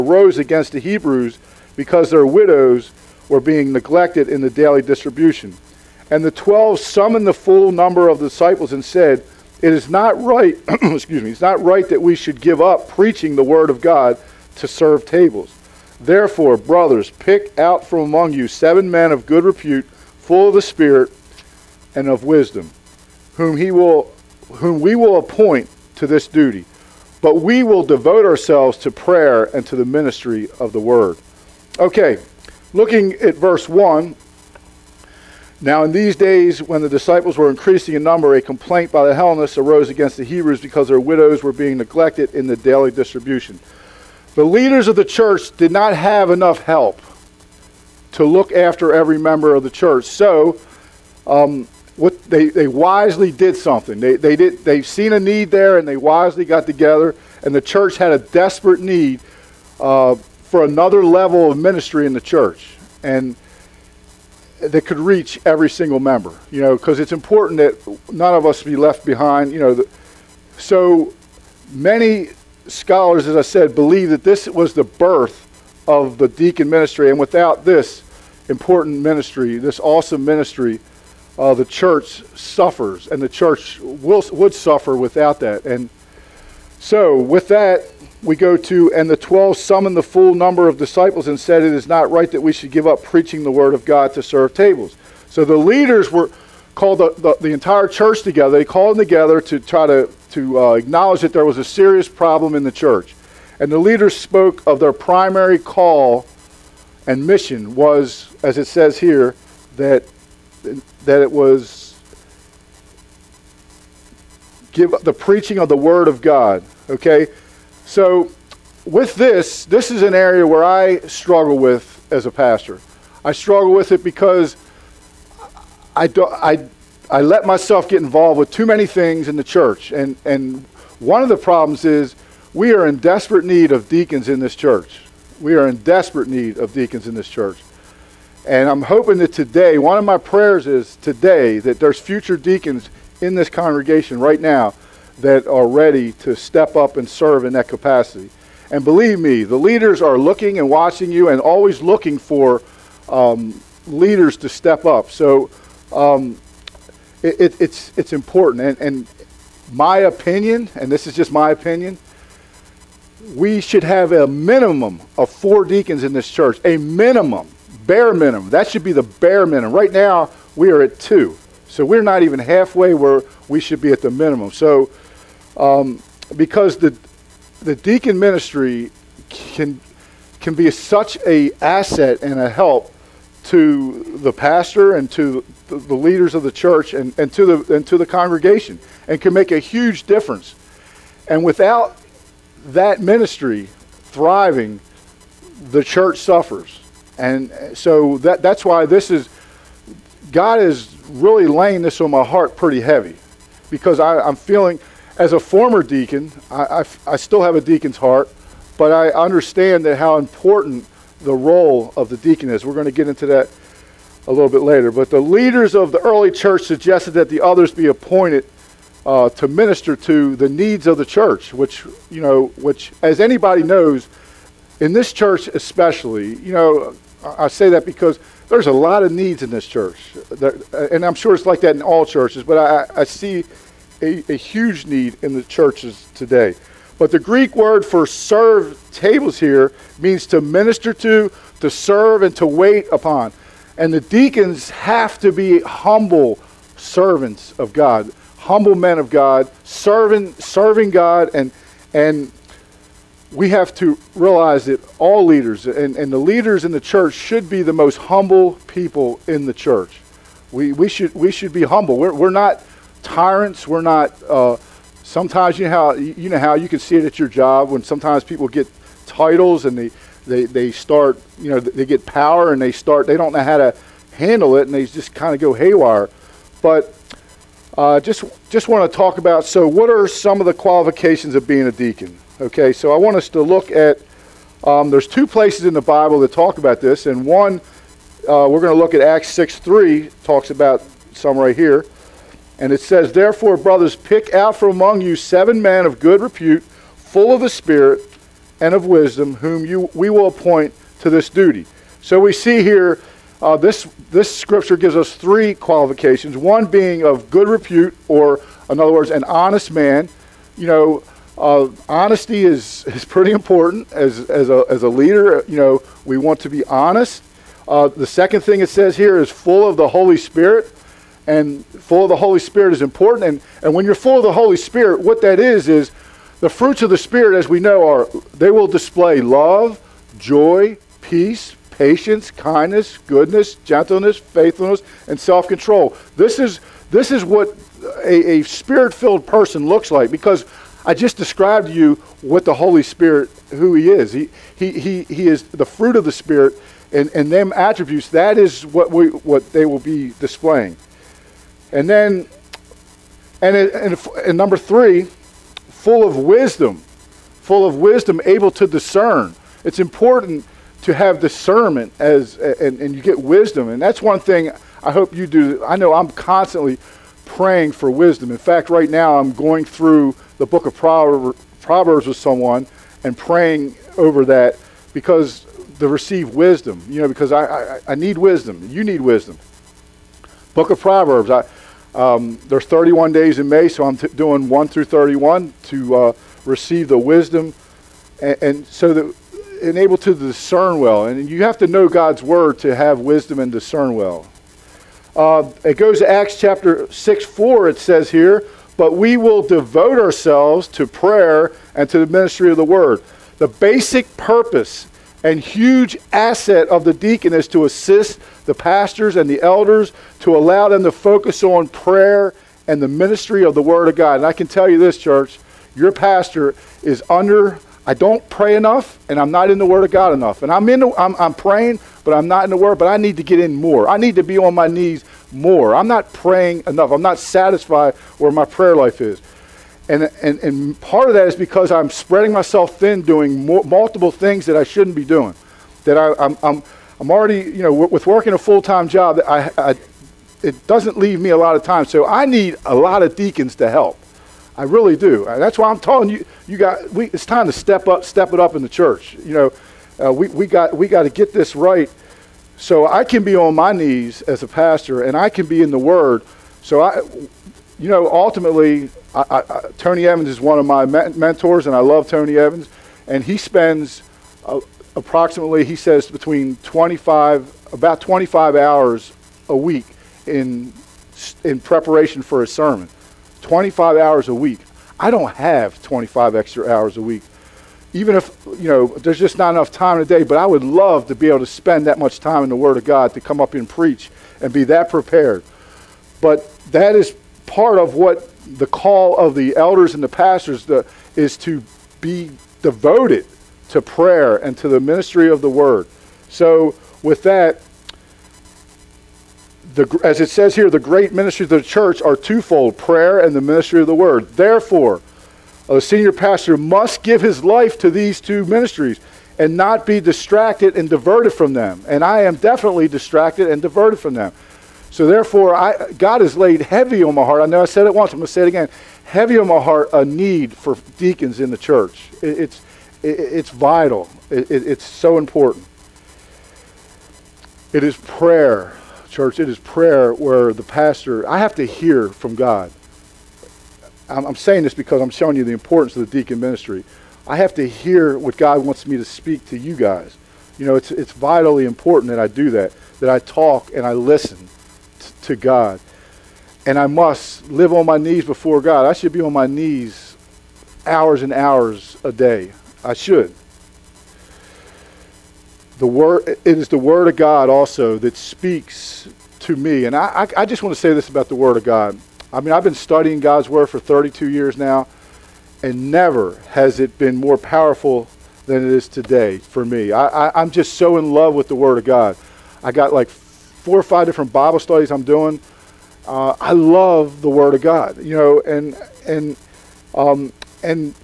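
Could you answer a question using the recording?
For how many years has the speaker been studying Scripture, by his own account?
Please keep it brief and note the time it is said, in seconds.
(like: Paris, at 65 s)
32, at 563 s.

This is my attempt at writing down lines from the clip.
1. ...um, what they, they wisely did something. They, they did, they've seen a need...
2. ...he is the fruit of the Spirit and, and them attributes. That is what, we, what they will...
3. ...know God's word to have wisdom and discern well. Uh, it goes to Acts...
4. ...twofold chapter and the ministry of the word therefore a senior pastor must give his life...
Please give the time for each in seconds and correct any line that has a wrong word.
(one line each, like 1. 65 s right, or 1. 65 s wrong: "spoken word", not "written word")
1. 51 s right
2. 345 s right
3. 391 s right
4. 502 s wrong: "prayer", not "chapter".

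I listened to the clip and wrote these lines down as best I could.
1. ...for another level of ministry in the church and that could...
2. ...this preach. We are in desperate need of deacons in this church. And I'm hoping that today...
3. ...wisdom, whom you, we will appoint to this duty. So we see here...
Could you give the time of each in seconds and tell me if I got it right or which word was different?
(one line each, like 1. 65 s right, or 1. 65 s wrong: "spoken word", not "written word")
1. 60 s right
2. 134 s wrong: "church", not "preach"
3. 298 s right.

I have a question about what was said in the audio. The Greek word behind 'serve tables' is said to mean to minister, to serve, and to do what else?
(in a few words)
wait upon.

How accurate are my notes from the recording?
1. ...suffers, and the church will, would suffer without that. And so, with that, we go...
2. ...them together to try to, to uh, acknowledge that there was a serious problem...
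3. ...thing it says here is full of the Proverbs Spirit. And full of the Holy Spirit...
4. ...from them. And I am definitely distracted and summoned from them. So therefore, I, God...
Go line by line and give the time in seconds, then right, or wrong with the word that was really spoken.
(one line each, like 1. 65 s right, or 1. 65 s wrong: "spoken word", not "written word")
1. 82 s right
2. 98 s right
3. 318 s wrong: "Holy", not "Proverbs"
4. 511 s wrong: "diverted", not "summoned".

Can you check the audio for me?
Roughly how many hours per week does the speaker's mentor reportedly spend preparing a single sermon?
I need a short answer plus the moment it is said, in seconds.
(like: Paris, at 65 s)
25, at 467 s.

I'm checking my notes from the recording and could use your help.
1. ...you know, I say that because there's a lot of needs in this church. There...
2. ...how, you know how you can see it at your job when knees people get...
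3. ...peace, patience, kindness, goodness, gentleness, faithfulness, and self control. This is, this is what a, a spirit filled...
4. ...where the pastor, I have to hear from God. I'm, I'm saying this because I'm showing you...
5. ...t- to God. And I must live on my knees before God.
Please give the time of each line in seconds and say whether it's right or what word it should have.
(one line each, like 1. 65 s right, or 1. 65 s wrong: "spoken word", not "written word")
1. 226 s right
2. 265 s wrong: "sometimes", not "knees"
3. 331 s right
4. 530 s right
5. 544 s right.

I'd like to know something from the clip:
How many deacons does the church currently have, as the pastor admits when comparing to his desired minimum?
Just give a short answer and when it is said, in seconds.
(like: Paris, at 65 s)
2, at 169 s.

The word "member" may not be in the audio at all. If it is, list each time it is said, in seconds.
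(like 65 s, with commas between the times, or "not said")
49 s, 65 s.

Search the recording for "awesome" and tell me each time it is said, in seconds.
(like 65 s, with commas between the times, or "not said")
79 s.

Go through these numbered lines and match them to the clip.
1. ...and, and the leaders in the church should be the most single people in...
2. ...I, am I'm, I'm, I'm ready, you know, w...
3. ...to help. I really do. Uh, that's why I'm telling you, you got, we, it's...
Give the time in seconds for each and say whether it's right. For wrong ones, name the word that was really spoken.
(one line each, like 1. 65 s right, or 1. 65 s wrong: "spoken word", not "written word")
1. 255 s wrong: "humble", not "single"
2. 435 s wrong: "already", not "ready"
3. 443 s right.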